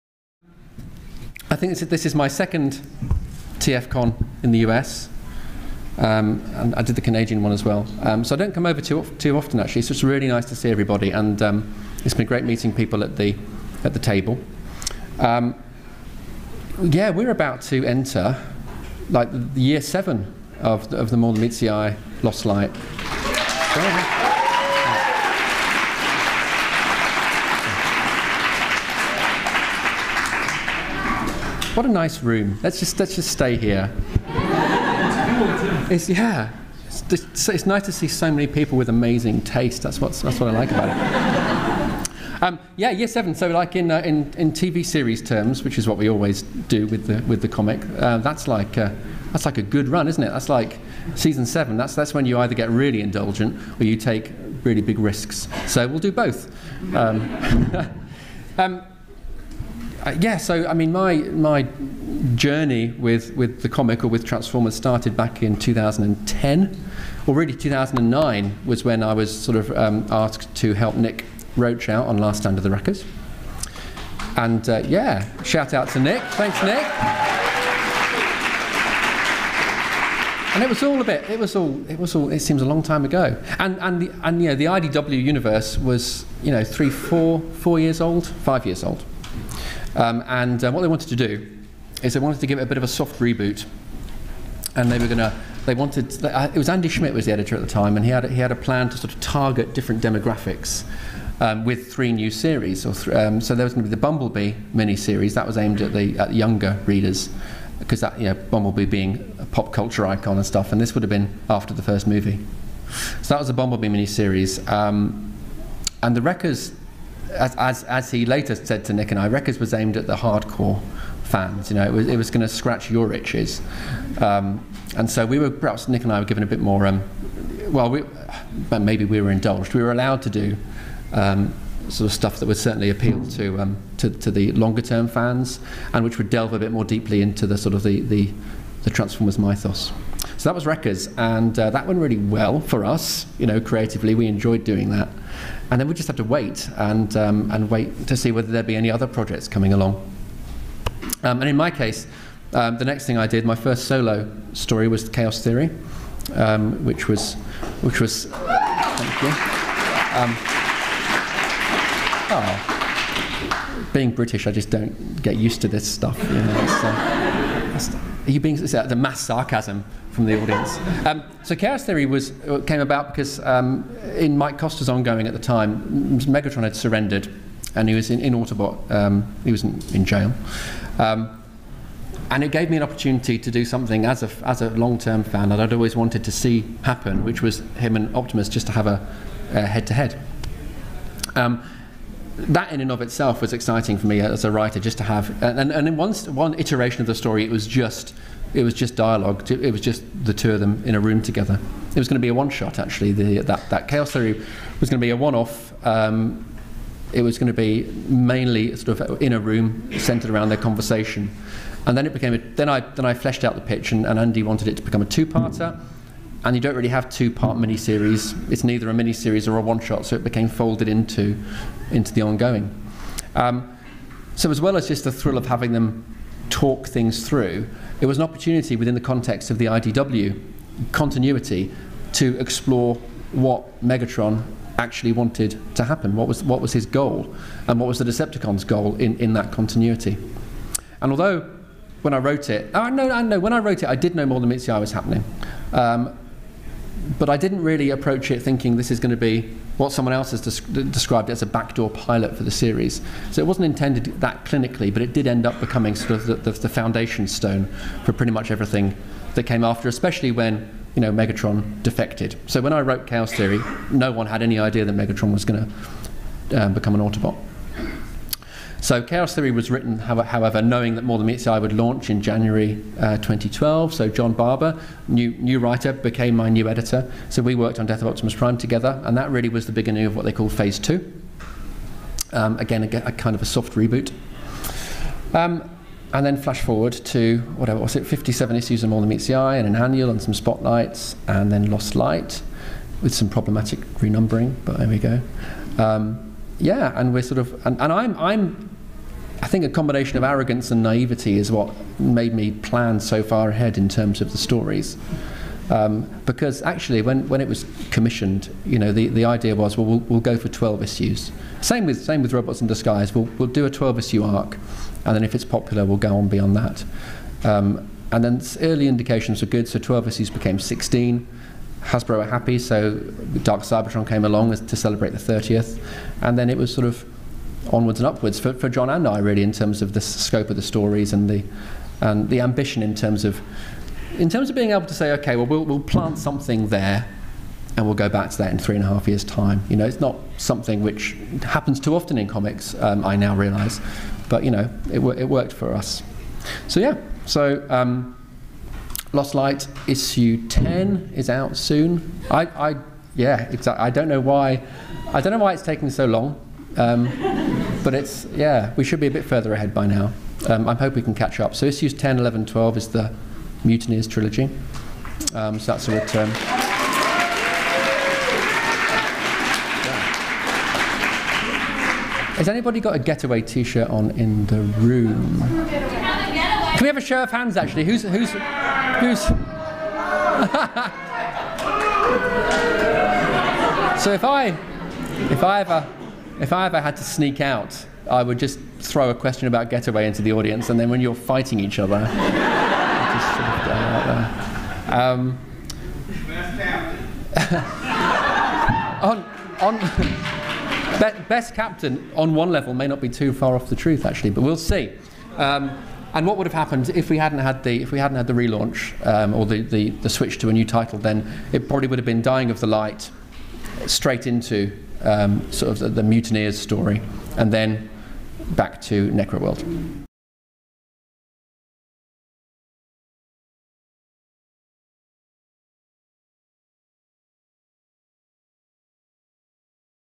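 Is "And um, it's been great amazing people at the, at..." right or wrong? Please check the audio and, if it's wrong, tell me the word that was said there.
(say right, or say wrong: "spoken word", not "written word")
wrong: "meeting", not "amazing".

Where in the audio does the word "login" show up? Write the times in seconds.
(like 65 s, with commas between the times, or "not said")
not said.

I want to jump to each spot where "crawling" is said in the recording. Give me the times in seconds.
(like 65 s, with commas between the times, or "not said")
not said.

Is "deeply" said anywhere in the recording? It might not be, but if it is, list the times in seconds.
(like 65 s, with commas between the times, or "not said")
136 s.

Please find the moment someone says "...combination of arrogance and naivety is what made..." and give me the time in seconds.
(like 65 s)
299 s.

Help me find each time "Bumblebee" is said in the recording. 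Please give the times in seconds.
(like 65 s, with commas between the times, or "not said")
104 s, 108 s, 113 s.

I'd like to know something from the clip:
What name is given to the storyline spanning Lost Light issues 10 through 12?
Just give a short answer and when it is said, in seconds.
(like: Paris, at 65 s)
Mutineers trilogy, at 363 s.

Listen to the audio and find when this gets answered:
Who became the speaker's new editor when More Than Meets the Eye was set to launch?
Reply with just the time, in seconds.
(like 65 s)
274 s.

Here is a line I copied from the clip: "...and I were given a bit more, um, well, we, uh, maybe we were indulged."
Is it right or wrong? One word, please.
right.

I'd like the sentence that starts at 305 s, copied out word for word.
Um, because actually, when, when it was commissioned, you know, the, the idea was, well, well, we'll go for 12 issues.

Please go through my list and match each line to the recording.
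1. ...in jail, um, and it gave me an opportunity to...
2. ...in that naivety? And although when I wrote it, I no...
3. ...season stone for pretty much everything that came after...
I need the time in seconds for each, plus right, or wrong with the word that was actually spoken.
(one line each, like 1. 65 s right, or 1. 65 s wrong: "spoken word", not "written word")
1. 179 s right
2. 239 s wrong: "continuity", not "naivety"
3. 256 s wrong: "foundation", not "season".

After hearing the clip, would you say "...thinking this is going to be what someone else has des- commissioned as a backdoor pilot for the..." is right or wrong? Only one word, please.
wrong.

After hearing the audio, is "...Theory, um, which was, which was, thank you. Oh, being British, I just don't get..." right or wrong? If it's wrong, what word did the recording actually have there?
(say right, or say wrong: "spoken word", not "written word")
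right.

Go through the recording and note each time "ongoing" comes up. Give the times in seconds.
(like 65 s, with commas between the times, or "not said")
174 s, 222 s.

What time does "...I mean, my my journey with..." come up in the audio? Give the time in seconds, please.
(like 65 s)
60 s.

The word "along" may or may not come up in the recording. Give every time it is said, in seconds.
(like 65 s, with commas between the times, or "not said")
149 s, 324 s.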